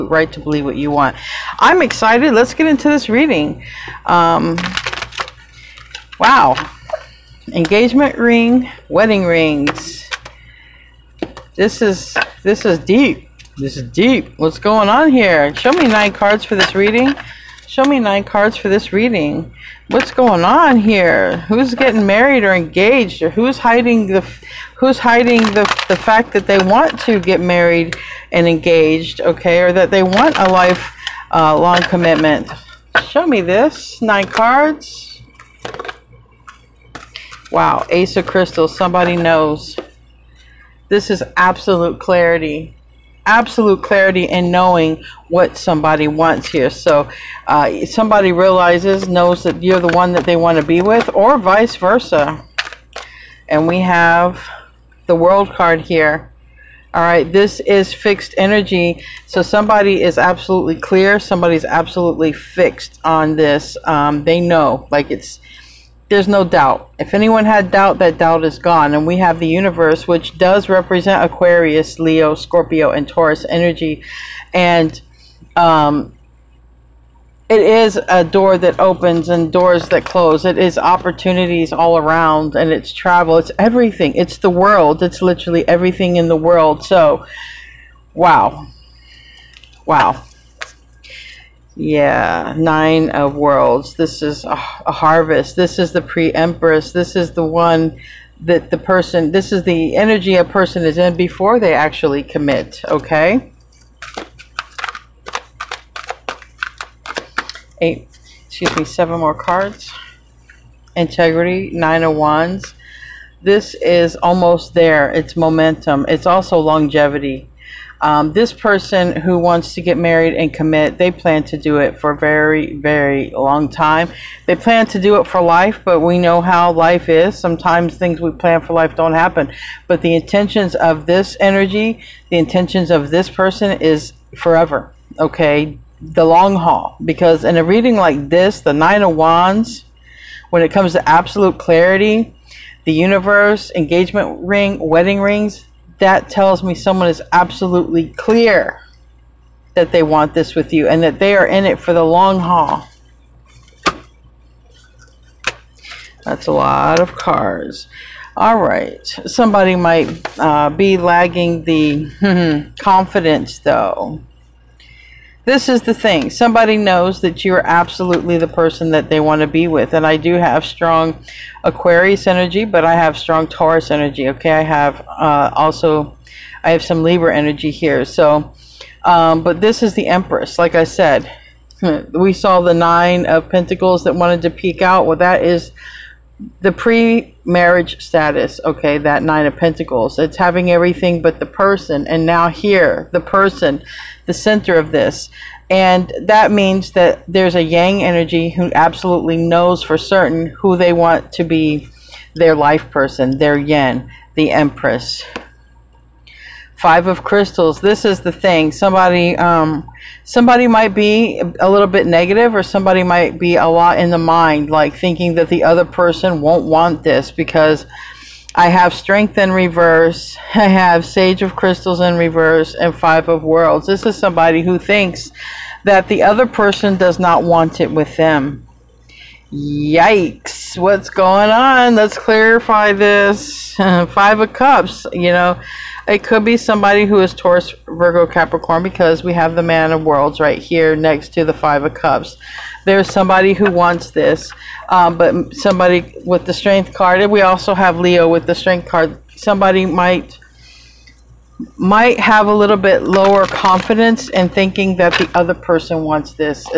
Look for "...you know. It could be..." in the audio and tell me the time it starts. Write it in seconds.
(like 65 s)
235 s.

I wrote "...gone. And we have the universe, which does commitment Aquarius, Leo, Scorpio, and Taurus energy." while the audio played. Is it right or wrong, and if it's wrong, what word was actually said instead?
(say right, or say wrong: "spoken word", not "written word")
wrong: "represent", not "commitment".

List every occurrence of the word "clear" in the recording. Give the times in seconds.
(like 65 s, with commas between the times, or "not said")
60 s, 148 s.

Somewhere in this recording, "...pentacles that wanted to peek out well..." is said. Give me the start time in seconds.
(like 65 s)
183 s.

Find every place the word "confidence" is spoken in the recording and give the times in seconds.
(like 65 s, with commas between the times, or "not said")
162 s, 253 s.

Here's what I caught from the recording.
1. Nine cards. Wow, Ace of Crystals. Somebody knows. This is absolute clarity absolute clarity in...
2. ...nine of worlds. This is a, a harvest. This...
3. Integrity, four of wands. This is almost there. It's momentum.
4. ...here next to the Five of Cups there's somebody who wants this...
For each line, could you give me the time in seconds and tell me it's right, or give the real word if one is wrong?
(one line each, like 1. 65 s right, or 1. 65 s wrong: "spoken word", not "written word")
1. 33 s right
2. 92 s right
3. 110 s wrong: "nine", not "four"
4. 240 s right.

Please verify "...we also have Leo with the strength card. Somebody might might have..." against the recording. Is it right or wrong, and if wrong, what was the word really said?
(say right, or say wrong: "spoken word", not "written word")
right.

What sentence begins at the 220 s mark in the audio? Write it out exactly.
I have Sage of Crystals in reverse and Five of Worlds.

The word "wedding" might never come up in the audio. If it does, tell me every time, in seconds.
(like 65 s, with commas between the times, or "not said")
8 s, 144 s.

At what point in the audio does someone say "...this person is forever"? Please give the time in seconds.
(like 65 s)
133 s.